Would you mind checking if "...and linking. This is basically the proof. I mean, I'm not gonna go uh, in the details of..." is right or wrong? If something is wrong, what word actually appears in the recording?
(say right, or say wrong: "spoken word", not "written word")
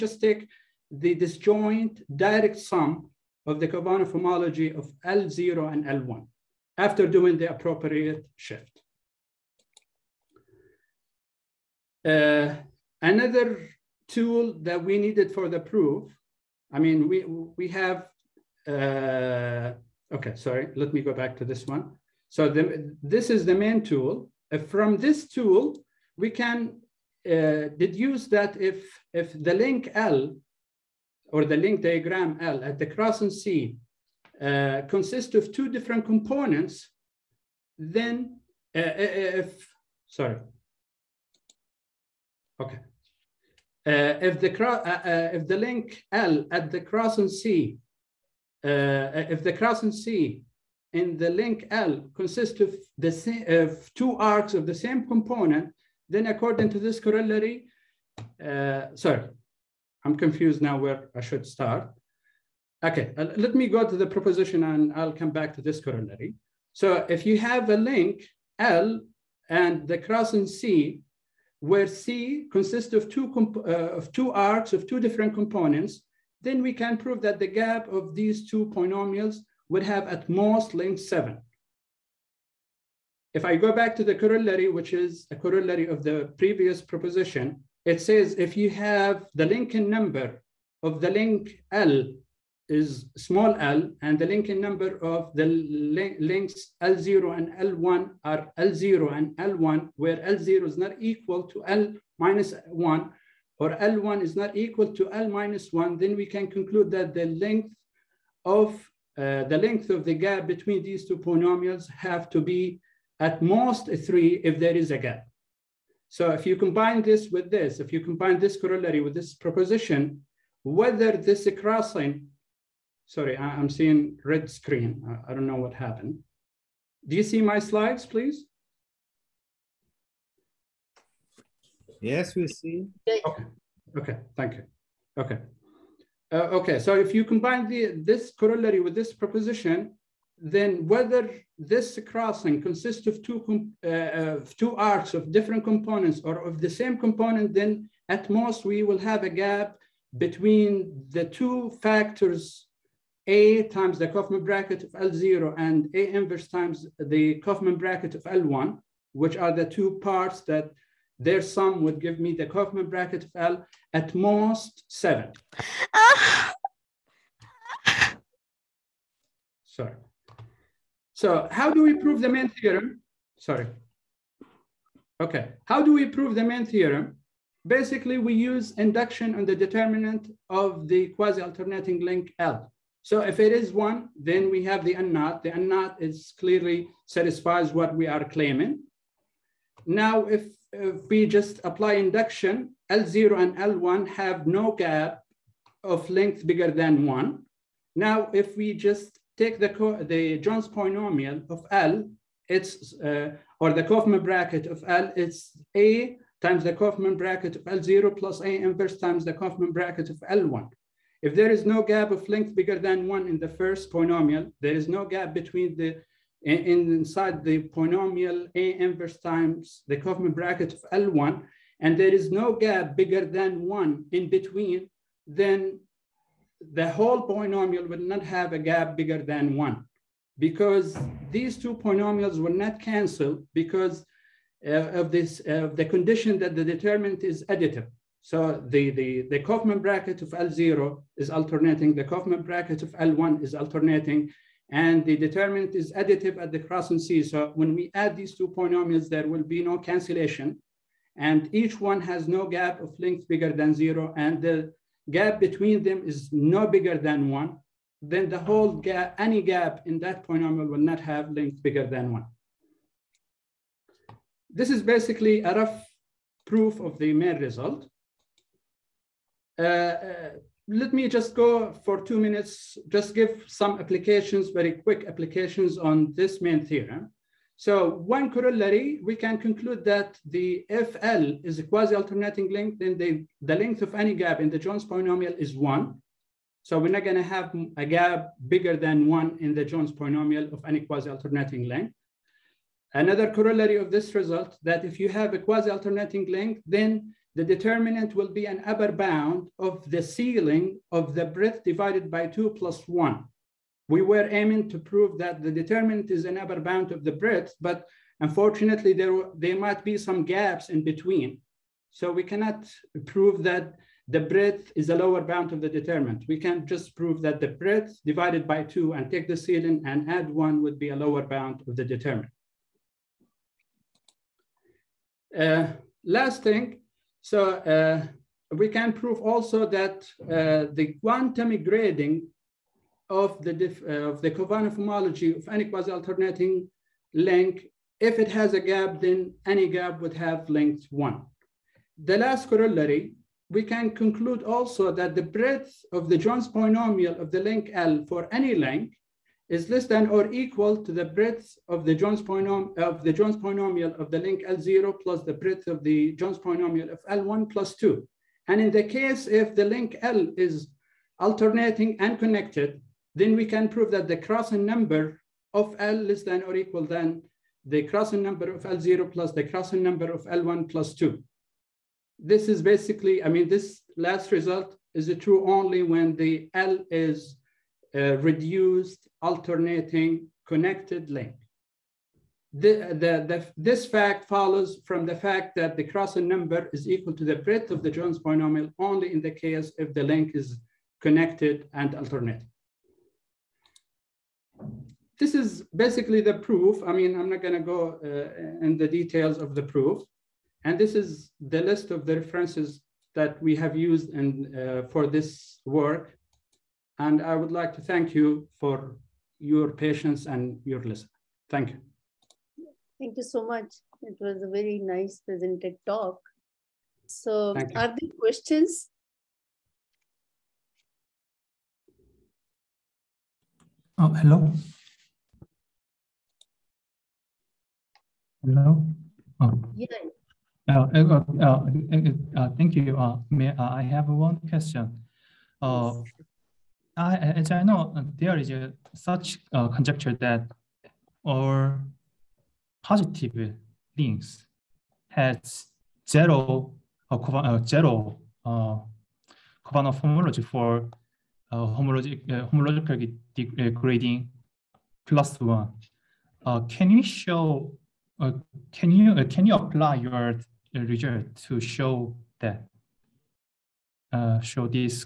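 wrong: "alternating", not "linking".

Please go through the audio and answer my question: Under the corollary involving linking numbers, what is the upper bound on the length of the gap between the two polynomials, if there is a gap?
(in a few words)
3.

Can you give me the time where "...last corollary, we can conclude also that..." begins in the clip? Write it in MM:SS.
05:42.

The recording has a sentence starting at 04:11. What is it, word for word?
And each one has no gap of length bigger than zero.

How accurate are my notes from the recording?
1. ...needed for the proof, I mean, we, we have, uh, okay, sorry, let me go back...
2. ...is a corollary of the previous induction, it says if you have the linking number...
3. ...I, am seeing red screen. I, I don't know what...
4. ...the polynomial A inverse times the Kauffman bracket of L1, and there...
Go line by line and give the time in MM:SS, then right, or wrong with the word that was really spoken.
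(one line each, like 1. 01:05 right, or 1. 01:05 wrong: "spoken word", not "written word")
1. 00:14 right
2. 01:24 wrong: "proposition", not "induction"
3. 02:03 right
4. 03:37 right.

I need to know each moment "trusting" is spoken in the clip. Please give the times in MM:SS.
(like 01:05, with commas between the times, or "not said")
not said.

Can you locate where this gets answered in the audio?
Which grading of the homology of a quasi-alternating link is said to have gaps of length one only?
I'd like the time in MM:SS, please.
05:30.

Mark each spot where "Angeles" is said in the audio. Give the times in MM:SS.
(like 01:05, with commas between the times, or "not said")
not said.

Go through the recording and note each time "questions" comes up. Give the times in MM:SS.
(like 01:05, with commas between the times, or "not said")
06:58, 07:14.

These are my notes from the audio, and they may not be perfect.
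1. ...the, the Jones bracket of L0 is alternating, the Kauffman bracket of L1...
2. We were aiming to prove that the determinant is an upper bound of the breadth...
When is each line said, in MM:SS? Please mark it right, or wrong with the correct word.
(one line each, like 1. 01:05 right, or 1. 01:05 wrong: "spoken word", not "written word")
1. 03:58 wrong: "Kauffman", not "Jones"
2. 05:03 right.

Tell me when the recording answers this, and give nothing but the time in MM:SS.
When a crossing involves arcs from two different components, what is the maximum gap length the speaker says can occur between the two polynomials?
01:20.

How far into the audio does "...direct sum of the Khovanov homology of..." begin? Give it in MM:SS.
00:02.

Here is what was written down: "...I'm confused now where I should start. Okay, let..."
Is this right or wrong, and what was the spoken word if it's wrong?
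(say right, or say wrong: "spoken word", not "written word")
right.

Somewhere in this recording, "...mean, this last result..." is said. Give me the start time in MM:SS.
06:13.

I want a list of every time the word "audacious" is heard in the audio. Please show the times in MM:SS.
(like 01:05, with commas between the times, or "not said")
not said.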